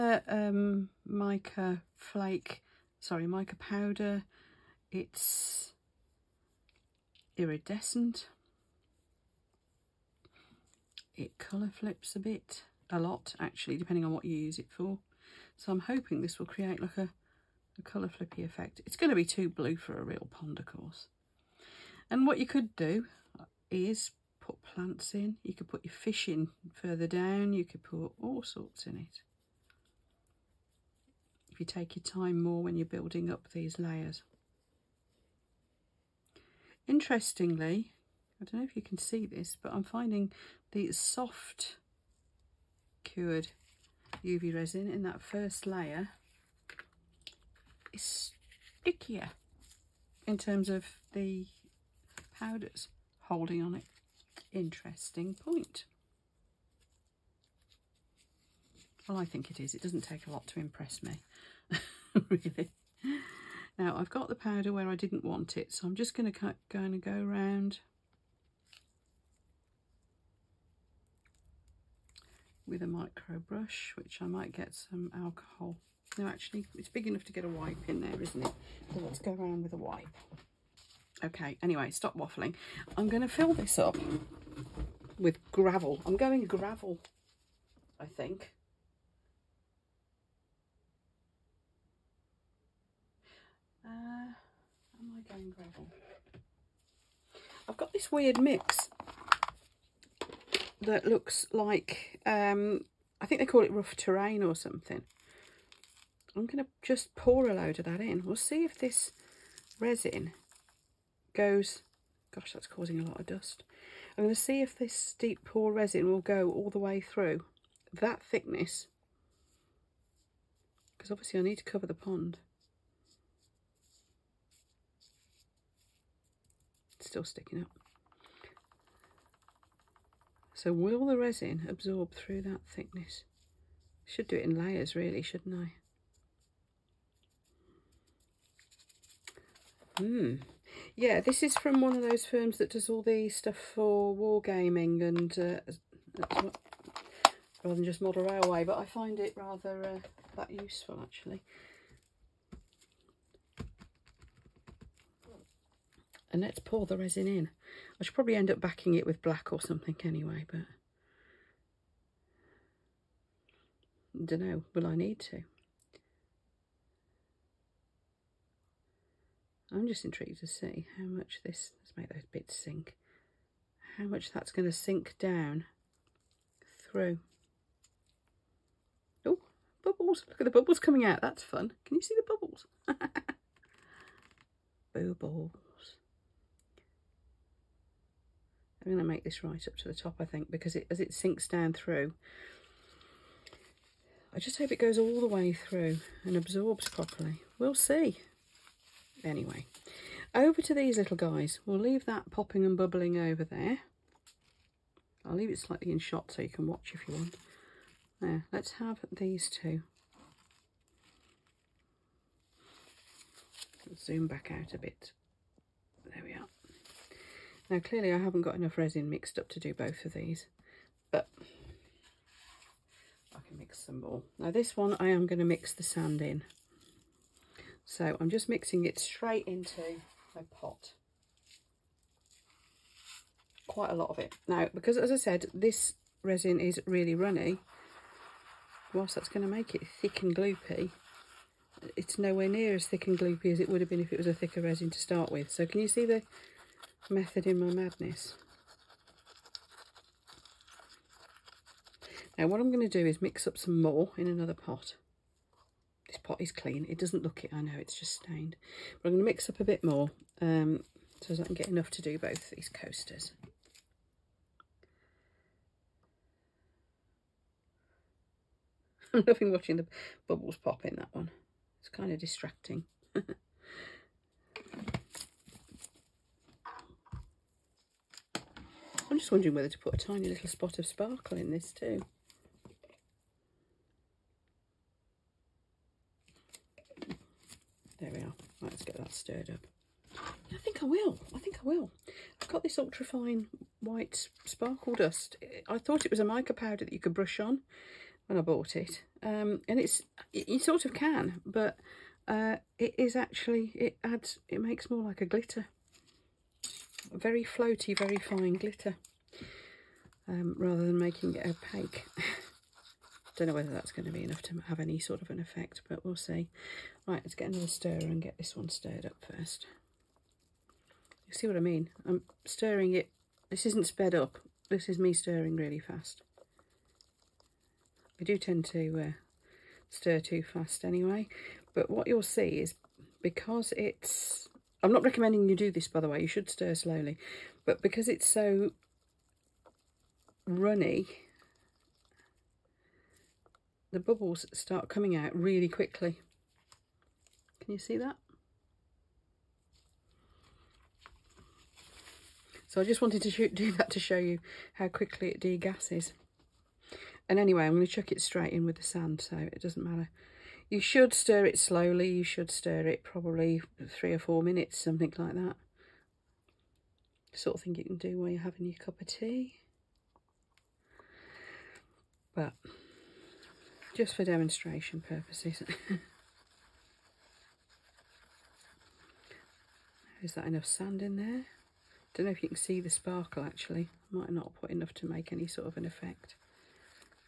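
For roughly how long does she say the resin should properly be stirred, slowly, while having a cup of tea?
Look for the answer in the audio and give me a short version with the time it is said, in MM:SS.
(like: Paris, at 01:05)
3 or 4 minutes, at 06:03.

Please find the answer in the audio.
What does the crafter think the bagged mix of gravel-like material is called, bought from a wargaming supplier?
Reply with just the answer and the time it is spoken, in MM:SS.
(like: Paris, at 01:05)
rough terrain, at 01:43.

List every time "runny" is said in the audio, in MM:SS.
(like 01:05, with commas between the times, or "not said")
03:57, 05:40.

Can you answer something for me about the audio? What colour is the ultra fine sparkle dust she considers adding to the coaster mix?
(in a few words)
white.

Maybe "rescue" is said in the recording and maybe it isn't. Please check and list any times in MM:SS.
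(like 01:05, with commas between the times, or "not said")
not said.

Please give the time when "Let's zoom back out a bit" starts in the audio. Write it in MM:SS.
03:33.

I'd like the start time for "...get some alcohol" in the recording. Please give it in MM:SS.
01:14.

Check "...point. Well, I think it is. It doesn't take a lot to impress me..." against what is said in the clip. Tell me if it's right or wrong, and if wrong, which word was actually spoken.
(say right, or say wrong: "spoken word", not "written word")
right.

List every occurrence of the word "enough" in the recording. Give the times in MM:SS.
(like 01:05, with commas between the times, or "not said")
01:17, 03:38, 04:21, 05:14, 06:20, 06:24.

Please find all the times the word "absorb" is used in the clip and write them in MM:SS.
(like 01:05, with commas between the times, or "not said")
02:11, 03:16.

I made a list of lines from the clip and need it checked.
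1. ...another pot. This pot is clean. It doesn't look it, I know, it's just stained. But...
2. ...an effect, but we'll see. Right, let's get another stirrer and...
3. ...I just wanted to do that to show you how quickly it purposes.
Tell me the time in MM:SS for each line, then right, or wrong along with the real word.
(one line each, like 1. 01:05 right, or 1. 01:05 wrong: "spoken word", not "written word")
1. 04:14 right
2. 05:15 right
3. 05:52 wrong: "degasses", not "purposes".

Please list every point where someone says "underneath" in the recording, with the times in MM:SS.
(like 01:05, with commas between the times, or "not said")
not said.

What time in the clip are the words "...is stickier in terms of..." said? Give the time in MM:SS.
00:47.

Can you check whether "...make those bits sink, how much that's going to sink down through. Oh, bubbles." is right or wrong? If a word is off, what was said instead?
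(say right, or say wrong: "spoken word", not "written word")
right.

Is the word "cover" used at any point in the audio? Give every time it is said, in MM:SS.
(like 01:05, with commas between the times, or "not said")
02:01.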